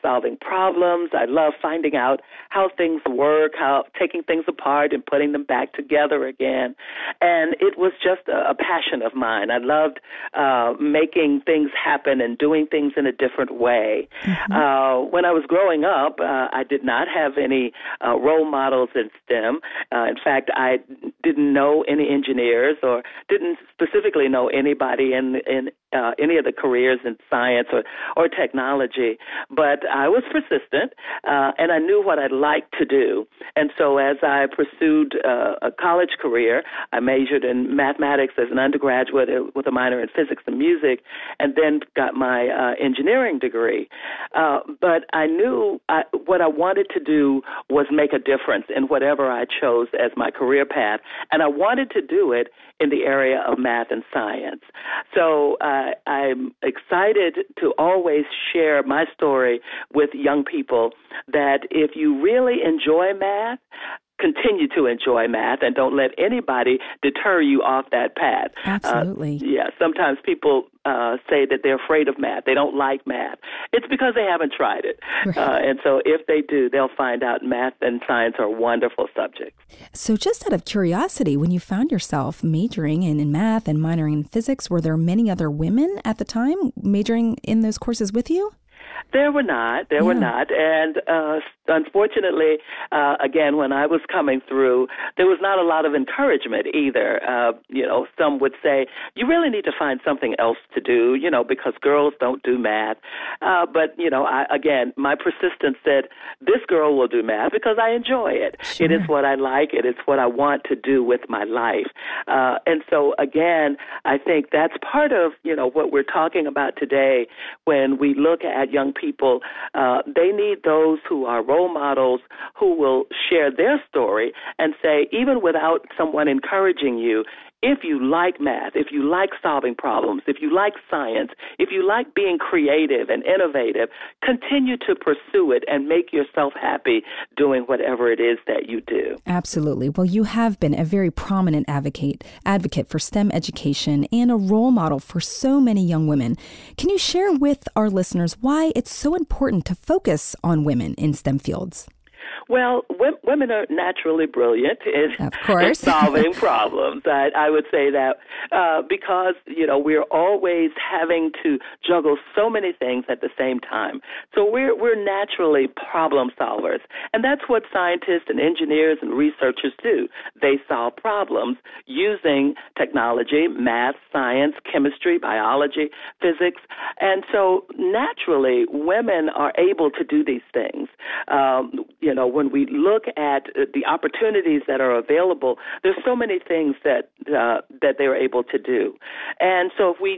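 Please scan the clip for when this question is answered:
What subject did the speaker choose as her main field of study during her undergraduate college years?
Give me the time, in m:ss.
0:37.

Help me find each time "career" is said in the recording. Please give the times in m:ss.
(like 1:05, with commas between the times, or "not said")
0:26, 0:36, 0:50.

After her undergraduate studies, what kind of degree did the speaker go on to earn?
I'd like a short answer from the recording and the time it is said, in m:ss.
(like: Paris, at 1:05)
Engineering degree, at 0:42.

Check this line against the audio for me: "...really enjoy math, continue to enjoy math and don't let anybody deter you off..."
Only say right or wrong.
right.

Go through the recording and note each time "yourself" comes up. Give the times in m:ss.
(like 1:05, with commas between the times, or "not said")
1:21, 2:16.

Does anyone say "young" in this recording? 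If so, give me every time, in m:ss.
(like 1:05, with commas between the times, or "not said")
1:00, 1:58, 2:25.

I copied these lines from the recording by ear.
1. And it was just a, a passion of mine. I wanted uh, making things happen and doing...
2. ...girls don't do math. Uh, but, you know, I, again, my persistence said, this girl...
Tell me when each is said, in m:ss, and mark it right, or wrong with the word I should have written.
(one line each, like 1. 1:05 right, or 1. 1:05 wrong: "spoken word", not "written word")
1. 0:07 wrong: "loved", not "wanted"
2. 1:41 right.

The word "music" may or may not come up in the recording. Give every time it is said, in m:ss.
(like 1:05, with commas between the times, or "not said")
0:40.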